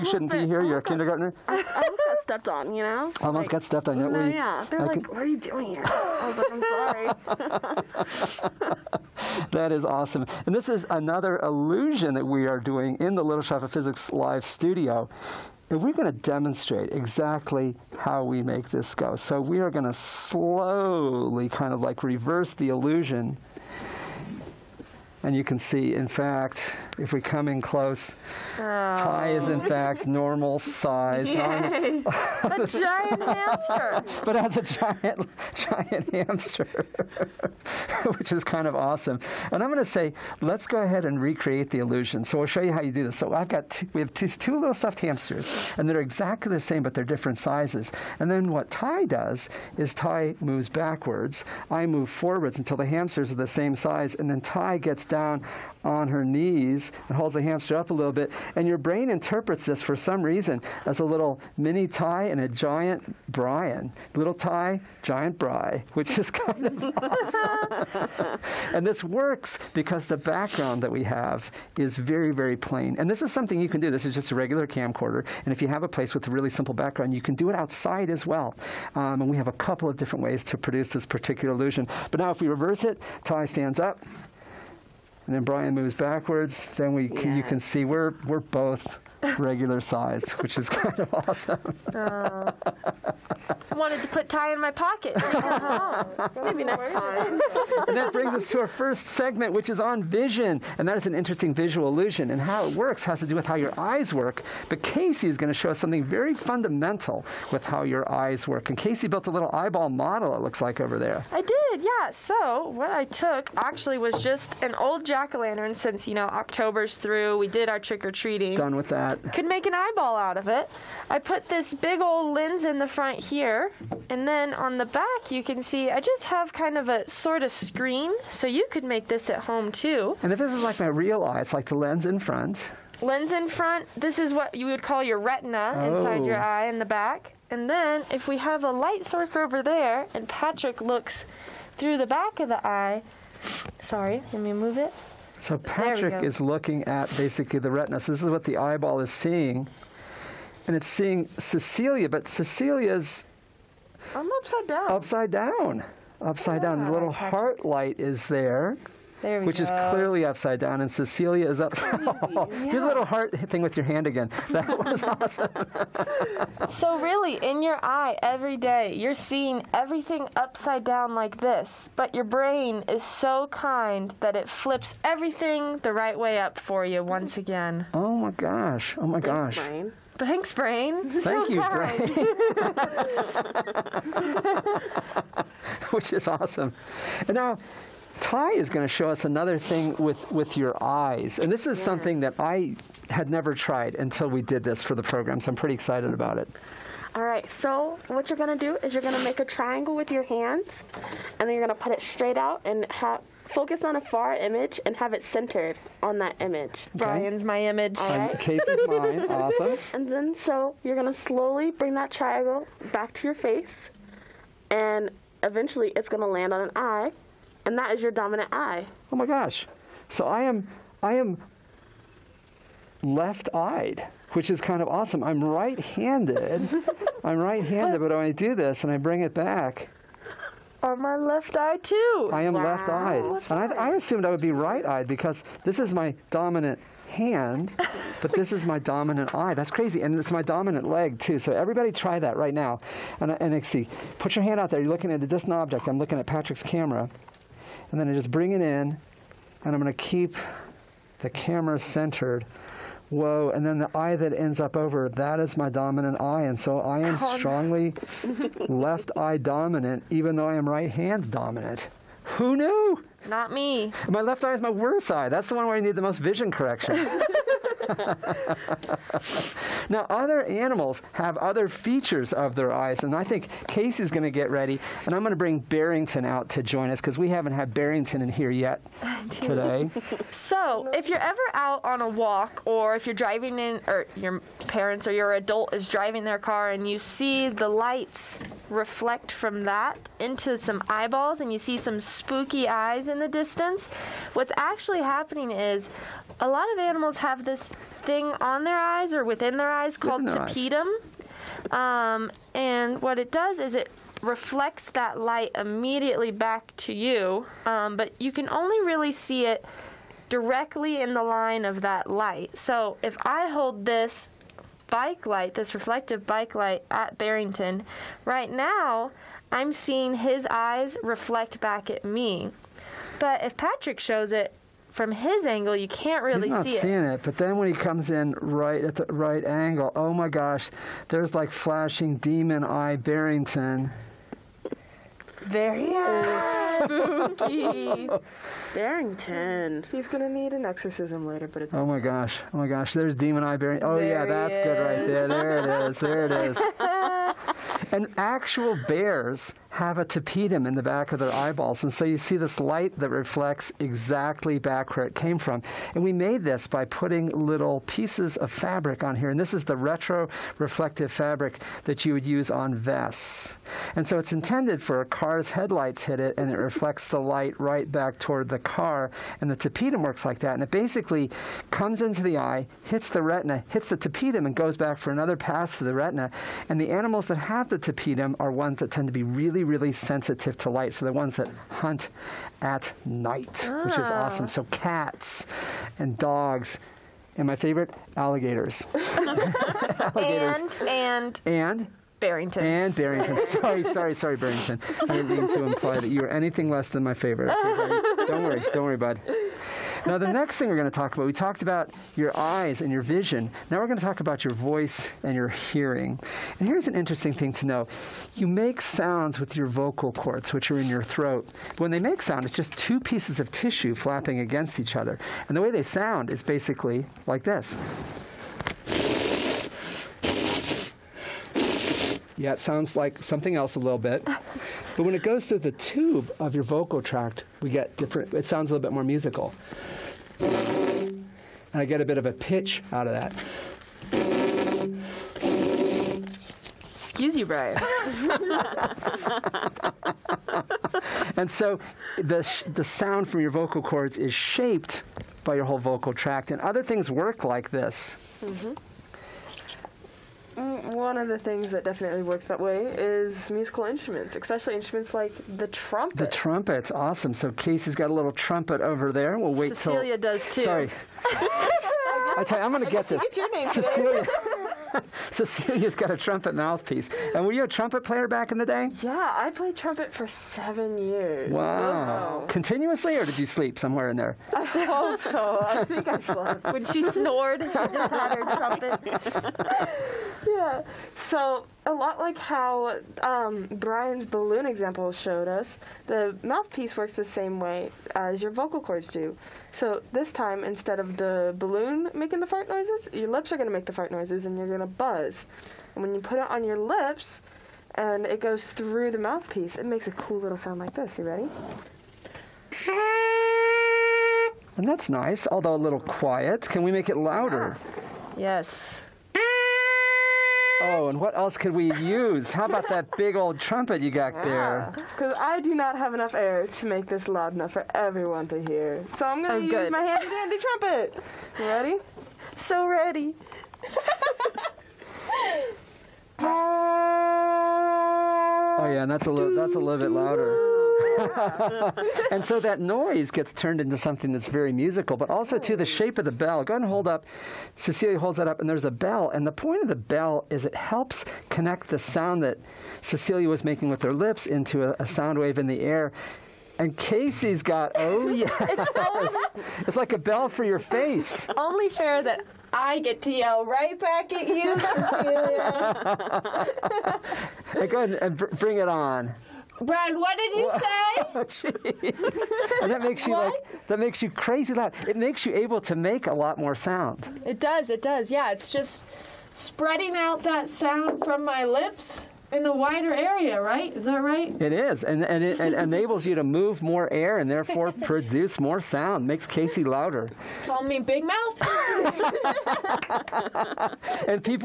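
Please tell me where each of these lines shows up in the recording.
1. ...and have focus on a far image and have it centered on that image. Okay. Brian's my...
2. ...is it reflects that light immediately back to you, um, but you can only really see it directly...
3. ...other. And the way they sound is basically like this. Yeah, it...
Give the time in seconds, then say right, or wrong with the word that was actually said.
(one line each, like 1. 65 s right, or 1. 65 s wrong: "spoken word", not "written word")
1. 202 s right
2. 303 s right
3. 414 s right.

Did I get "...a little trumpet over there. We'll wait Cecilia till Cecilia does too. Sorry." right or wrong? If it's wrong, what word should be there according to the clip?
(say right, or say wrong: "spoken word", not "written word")
right.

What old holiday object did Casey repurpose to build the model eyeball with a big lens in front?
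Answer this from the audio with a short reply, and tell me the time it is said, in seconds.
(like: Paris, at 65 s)
jack-o'-lantern, at 115 s.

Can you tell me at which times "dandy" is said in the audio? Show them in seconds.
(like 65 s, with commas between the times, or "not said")
520 s.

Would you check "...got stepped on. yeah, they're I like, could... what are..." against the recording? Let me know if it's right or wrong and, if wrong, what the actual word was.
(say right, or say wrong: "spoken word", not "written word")
right.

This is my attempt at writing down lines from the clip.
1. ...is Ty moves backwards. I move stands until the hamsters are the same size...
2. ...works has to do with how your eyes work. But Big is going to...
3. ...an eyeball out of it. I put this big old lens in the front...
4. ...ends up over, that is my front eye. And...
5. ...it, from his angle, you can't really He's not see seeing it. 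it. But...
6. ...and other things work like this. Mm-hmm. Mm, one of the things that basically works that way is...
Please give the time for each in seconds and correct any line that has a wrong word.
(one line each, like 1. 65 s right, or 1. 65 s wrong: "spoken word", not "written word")
1. 49 s wrong: "forwards", not "stands"
2. 102 s wrong: "Casey", not "Big"
3. 119 s right
4. 254 s wrong: "dominant", not "front"
5. 324 s right
6. 446 s wrong: "definitely", not "basically".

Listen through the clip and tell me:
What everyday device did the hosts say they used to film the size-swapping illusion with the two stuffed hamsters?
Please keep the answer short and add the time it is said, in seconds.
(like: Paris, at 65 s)
regular camcorder, at 74 s.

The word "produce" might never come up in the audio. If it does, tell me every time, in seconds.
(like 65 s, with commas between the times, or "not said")
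80 s, 578 s.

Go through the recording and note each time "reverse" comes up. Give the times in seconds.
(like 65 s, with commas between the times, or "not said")
22 s, 82 s.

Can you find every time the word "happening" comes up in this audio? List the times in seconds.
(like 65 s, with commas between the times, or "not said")
294 s.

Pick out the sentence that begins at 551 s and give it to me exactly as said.
Only fair that I get to yell right back at you, Cecilia.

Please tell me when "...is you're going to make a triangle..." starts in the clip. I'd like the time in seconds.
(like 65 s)
198 s.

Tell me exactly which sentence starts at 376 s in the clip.
And the animals that have the tapetum are ones that tend to be really, really sensitive to light.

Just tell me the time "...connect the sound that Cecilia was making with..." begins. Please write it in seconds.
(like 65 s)
541 s.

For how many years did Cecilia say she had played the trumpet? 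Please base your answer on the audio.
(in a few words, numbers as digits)
7.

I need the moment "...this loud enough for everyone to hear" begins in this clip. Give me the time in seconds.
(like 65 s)
517 s.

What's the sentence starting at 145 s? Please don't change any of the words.
So Patrick is looking at basically the retina.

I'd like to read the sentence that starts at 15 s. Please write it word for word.
And we're going to demonstrate exactly how we make this go.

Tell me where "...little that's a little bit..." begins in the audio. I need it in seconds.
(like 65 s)
529 s.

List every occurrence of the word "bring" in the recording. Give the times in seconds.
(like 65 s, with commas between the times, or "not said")
98 s, 211 s, 228 s, 248 s, 275 s, 558 s.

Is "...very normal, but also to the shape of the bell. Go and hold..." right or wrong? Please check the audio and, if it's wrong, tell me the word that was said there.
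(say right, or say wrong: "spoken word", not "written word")
wrong: "musical", not "normal".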